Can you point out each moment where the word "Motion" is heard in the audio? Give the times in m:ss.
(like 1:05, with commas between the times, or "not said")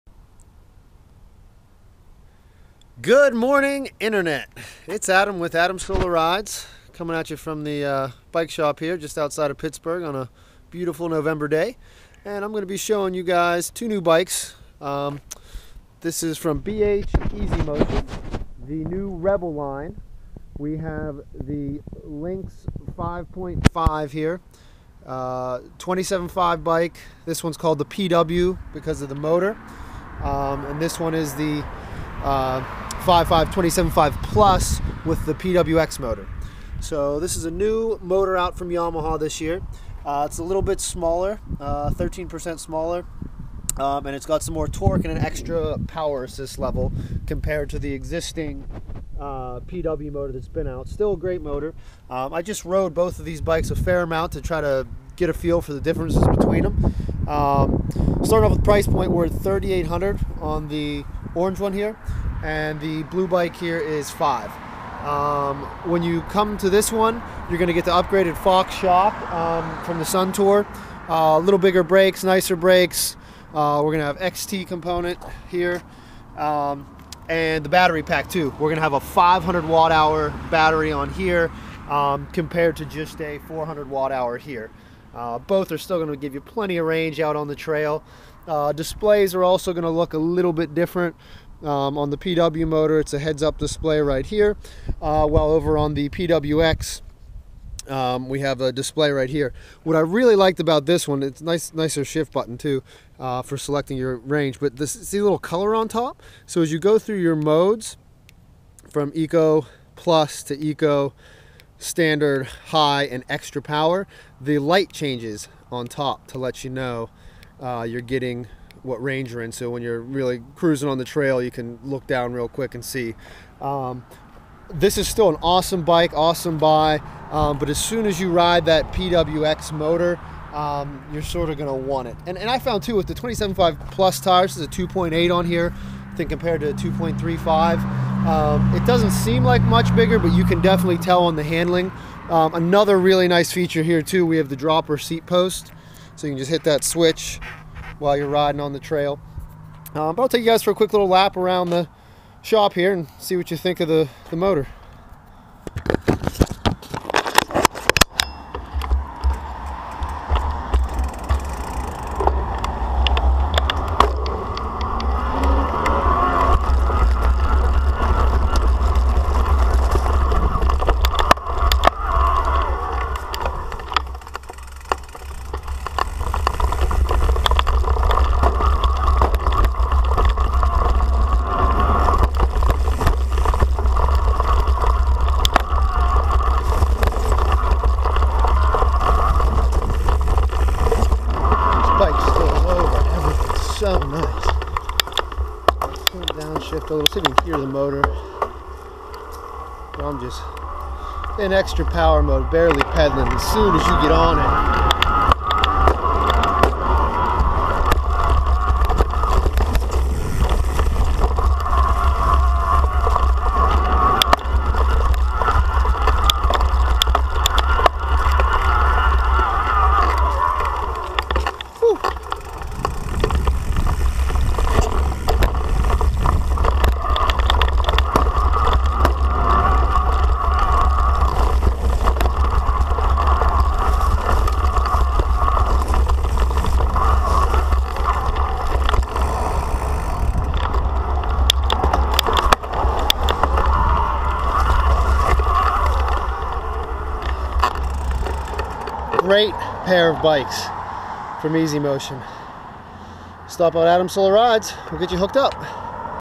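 0:17, 4:11.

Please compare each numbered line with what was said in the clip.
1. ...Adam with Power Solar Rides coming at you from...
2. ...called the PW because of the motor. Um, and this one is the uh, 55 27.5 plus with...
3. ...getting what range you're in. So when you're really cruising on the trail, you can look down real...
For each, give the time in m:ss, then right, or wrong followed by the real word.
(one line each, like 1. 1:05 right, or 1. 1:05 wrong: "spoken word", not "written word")
1. 0:05 wrong: "Adam", not "Power"
2. 0:27 right
3. 1:58 right.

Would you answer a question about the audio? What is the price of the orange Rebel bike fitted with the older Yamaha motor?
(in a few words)
$3,800.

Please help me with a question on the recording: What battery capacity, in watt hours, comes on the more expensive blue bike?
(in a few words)
500 watt hours.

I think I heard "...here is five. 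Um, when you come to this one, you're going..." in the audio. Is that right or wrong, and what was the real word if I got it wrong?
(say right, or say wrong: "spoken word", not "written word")
right.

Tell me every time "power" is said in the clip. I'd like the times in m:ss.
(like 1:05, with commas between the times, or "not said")
0:45, 1:53, 3:21.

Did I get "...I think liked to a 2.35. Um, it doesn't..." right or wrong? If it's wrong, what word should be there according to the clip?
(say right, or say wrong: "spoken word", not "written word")
wrong: "compared", not "liked".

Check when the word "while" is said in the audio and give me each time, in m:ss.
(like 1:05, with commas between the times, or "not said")
1:35, 2:27.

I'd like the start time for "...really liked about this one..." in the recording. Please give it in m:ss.
1:40.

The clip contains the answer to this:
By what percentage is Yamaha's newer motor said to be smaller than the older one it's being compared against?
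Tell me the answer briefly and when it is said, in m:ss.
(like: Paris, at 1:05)
13%, at 0:41.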